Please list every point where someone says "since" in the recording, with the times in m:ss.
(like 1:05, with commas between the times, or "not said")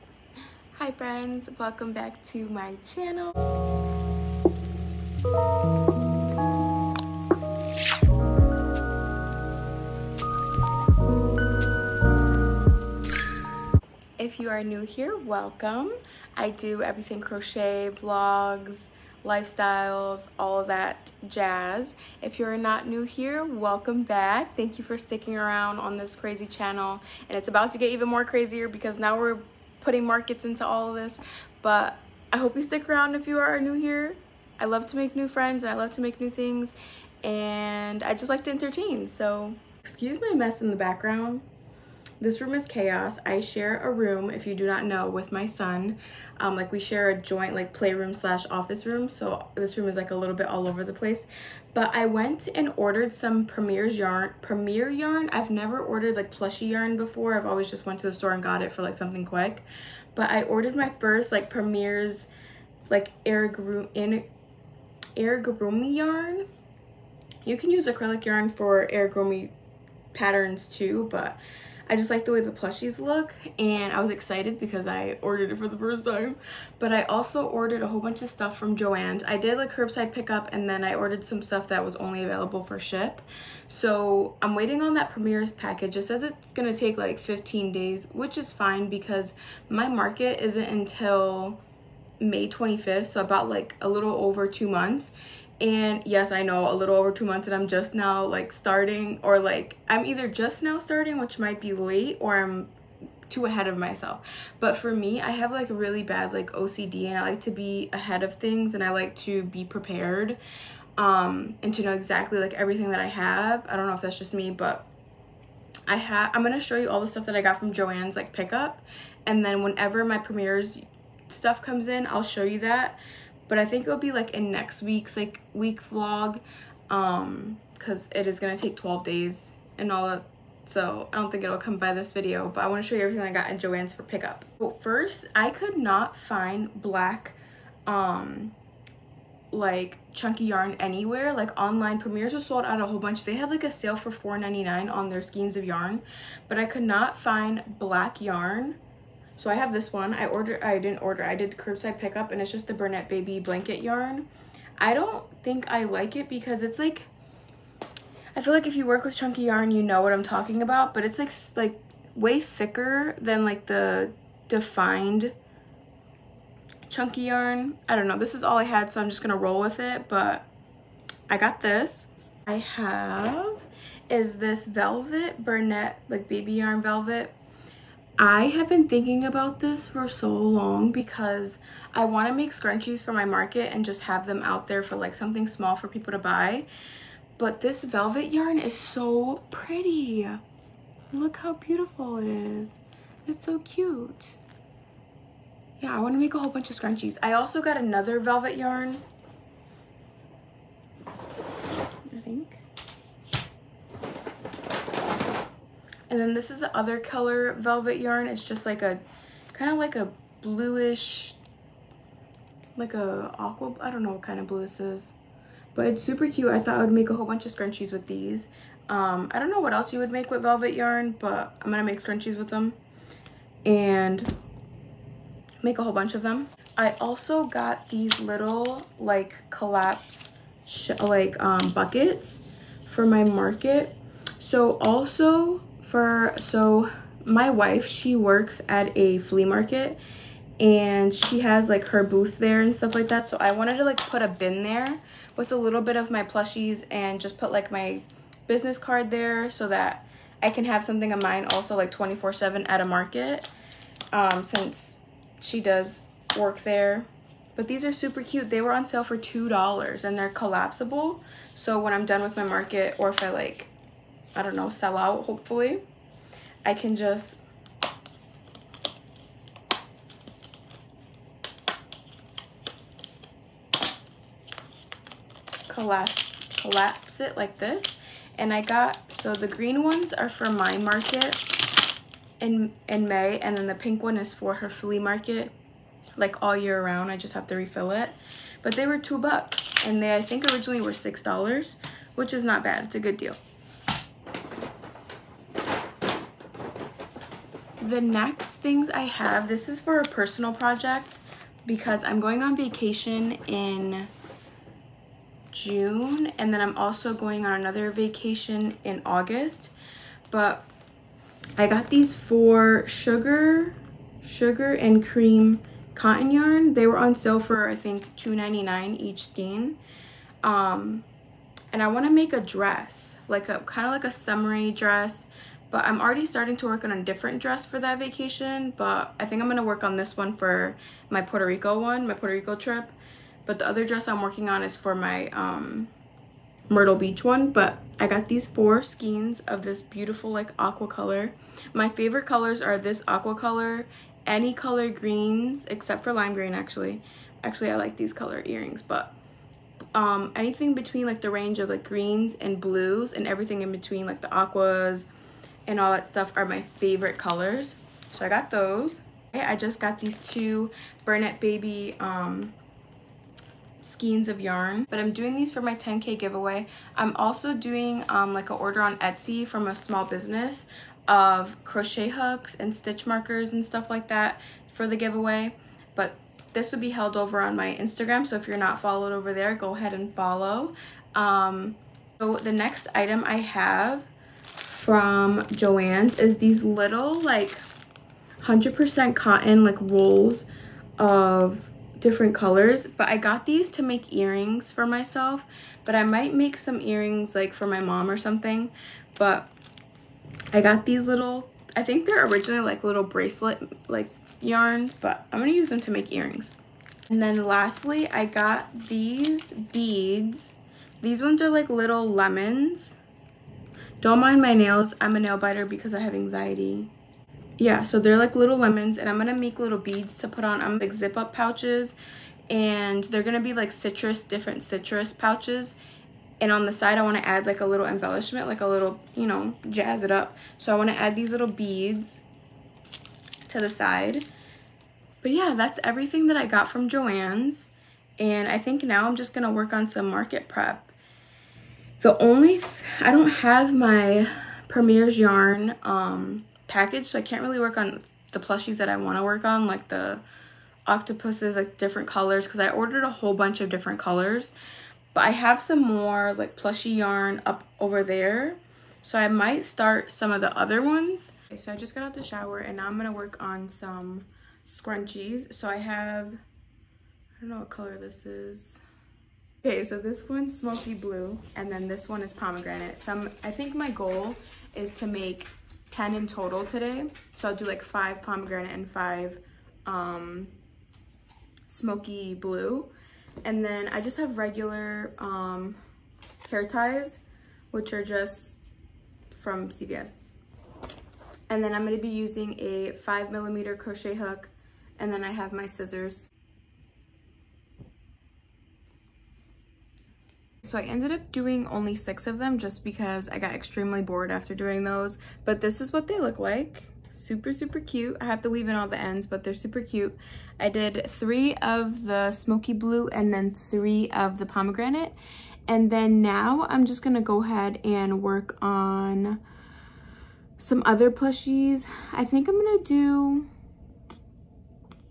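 4:14.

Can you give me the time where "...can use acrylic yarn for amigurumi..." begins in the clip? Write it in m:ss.
1:07.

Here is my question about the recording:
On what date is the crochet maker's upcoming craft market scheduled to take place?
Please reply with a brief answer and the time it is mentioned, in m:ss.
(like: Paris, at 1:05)
May 25th, at 1:32.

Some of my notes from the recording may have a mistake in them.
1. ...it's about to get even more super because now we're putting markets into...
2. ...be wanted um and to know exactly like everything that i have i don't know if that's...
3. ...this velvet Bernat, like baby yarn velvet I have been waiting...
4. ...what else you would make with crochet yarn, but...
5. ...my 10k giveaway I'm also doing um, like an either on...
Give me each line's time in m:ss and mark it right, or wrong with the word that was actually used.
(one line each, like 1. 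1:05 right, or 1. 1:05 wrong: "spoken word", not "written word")
1. 0:27 wrong: "crazier", not "super"
2. 1:49 wrong: "prepared", not "wanted"
3. 2:54 wrong: "thinking", not "waiting"
4. 3:39 wrong: "velvet", not "crochet"
5. 6:05 wrong: "order", not "either".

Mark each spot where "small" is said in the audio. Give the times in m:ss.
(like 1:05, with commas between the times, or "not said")
3:05, 6:09.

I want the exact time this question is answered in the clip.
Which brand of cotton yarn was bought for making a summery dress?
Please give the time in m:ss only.
5:14.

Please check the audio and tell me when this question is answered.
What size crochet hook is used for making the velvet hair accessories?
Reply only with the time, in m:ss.
8:12.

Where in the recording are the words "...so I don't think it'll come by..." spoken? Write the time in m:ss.
2:10.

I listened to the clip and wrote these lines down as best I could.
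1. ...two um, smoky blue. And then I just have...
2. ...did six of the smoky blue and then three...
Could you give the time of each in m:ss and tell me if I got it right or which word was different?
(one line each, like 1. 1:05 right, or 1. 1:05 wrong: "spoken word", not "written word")
1. 7:58 wrong: "five", not "two"
2. 8:30 wrong: "three", not "six".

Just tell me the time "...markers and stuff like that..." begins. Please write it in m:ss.
6:13.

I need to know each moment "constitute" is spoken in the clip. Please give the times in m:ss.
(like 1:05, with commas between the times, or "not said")
not said.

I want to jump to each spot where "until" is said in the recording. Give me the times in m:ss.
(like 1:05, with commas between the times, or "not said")
1:30.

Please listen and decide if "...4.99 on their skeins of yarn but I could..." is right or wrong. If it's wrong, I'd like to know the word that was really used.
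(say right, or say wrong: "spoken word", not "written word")
right.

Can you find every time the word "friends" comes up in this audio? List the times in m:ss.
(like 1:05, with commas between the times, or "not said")
0:00, 0:35.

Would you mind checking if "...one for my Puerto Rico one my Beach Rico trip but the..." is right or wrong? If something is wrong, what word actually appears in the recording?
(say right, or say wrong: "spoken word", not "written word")
wrong: "Puerto", not "Beach".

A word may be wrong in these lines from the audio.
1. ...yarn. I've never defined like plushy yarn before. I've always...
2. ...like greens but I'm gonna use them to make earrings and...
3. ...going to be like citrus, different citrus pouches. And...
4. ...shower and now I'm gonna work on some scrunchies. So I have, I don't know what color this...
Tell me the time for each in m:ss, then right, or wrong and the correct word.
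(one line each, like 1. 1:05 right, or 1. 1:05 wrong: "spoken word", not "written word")
1. 0:54 wrong: "ordered", not "defined"
2. 6:43 wrong: "yarns", not "greens"
3. 7:03 right
4. 7:42 right.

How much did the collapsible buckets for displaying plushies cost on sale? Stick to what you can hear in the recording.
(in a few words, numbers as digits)
$2.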